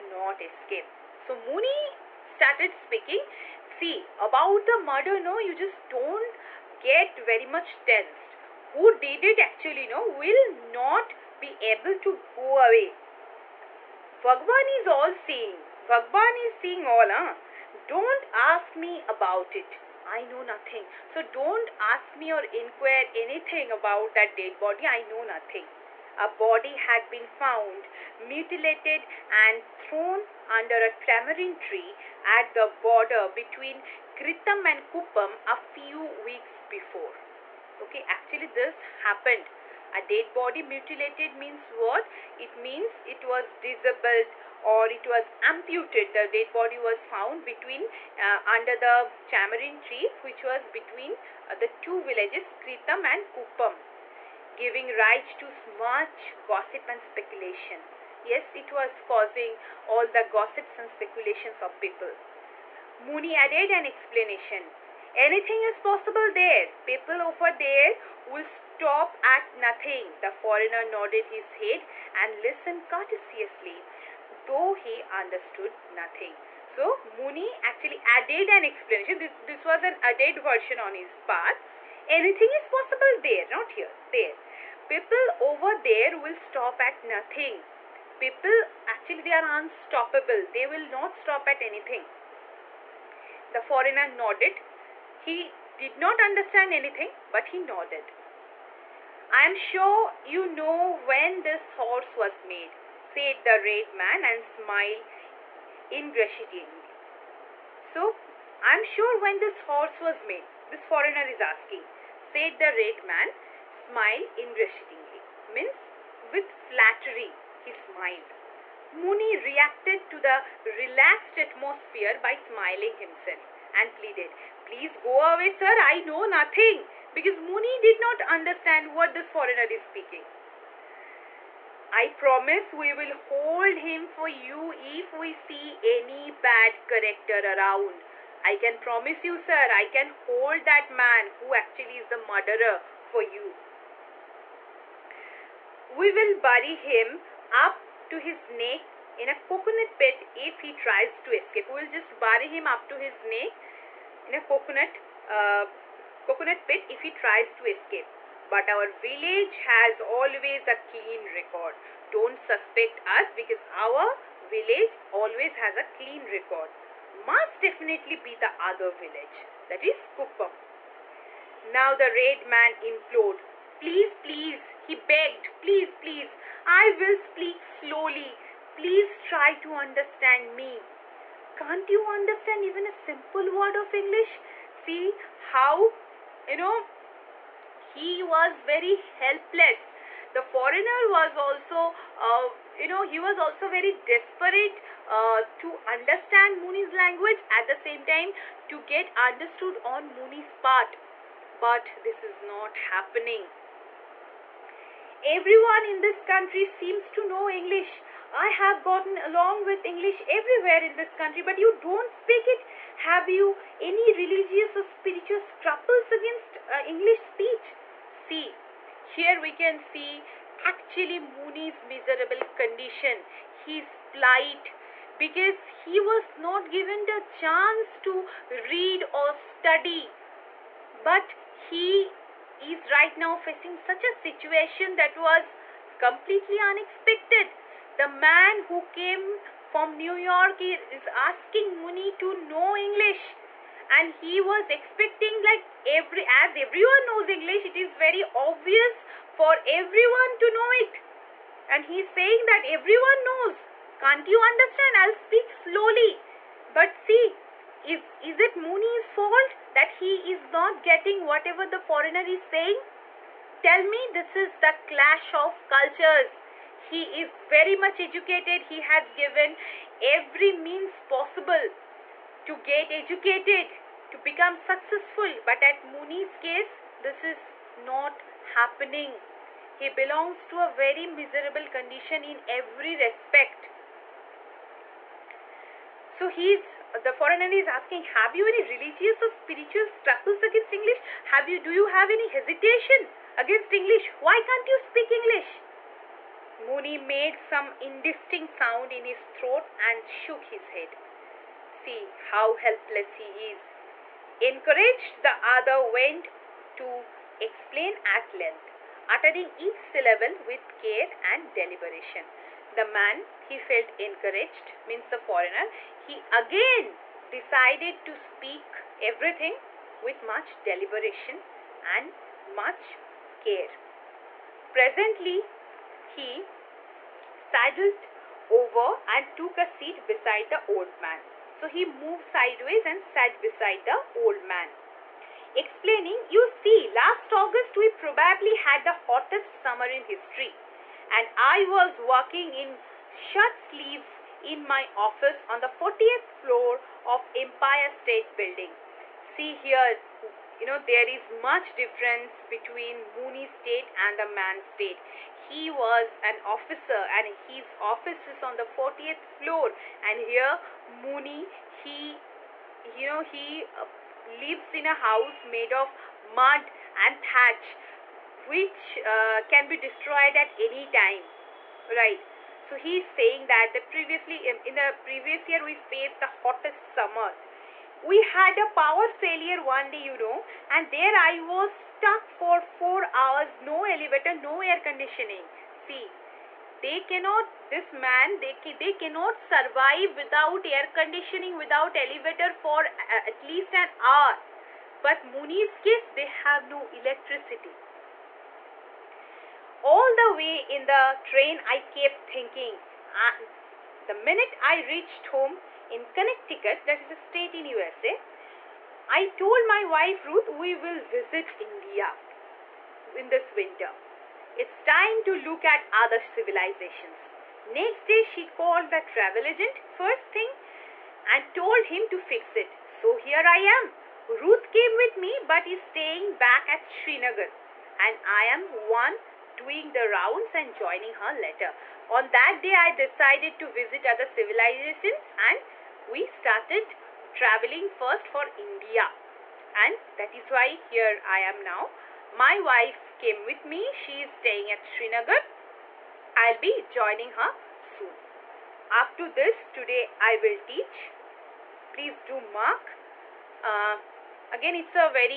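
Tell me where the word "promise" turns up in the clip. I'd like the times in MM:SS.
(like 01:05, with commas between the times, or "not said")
02:12, 02:18.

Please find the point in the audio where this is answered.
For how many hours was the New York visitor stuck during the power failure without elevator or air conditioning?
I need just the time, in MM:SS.
06:22.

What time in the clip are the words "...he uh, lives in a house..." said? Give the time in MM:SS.
06:03.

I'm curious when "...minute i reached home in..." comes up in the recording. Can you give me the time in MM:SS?
06:44.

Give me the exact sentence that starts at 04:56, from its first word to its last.
Muni made some indistinct sound in his throat and shook his head see how helpless he is.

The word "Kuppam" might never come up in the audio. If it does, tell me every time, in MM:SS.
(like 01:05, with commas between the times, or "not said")
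00:34, 00:53, 02:50.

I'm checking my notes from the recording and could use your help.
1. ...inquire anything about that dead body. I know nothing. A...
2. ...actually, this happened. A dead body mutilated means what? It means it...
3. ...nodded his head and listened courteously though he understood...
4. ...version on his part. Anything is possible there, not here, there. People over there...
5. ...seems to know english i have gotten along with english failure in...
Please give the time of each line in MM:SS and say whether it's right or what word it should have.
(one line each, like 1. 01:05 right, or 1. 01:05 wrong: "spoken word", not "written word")
1. 00:22 right
2. 00:38 right
3. 01:10 right
4. 01:20 right
5. 03:26 wrong: "everywhere", not "failure".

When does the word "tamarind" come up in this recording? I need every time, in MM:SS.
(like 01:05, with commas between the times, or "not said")
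00:30, 00:49.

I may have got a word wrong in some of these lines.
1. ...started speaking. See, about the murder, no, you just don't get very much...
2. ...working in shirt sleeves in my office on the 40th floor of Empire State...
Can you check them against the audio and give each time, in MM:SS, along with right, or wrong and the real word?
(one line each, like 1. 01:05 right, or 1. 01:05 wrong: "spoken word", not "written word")
1. 00:02 right
2. 05:41 right.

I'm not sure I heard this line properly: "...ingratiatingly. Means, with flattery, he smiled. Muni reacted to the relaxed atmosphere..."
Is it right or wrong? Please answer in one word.
right.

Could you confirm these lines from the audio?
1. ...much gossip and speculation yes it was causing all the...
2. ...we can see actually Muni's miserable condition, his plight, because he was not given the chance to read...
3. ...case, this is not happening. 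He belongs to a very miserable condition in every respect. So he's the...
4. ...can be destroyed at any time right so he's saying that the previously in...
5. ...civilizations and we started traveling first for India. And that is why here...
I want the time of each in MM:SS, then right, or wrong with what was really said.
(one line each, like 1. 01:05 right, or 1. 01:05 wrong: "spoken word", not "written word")
1. 00:55 right
2. 03:39 right
3. 04:36 right
4. 06:09 right
5. 07:14 right.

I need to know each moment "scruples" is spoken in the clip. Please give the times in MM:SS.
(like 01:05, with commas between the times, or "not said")
03:35.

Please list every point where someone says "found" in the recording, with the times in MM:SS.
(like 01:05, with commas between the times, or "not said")
00:27, 00:46.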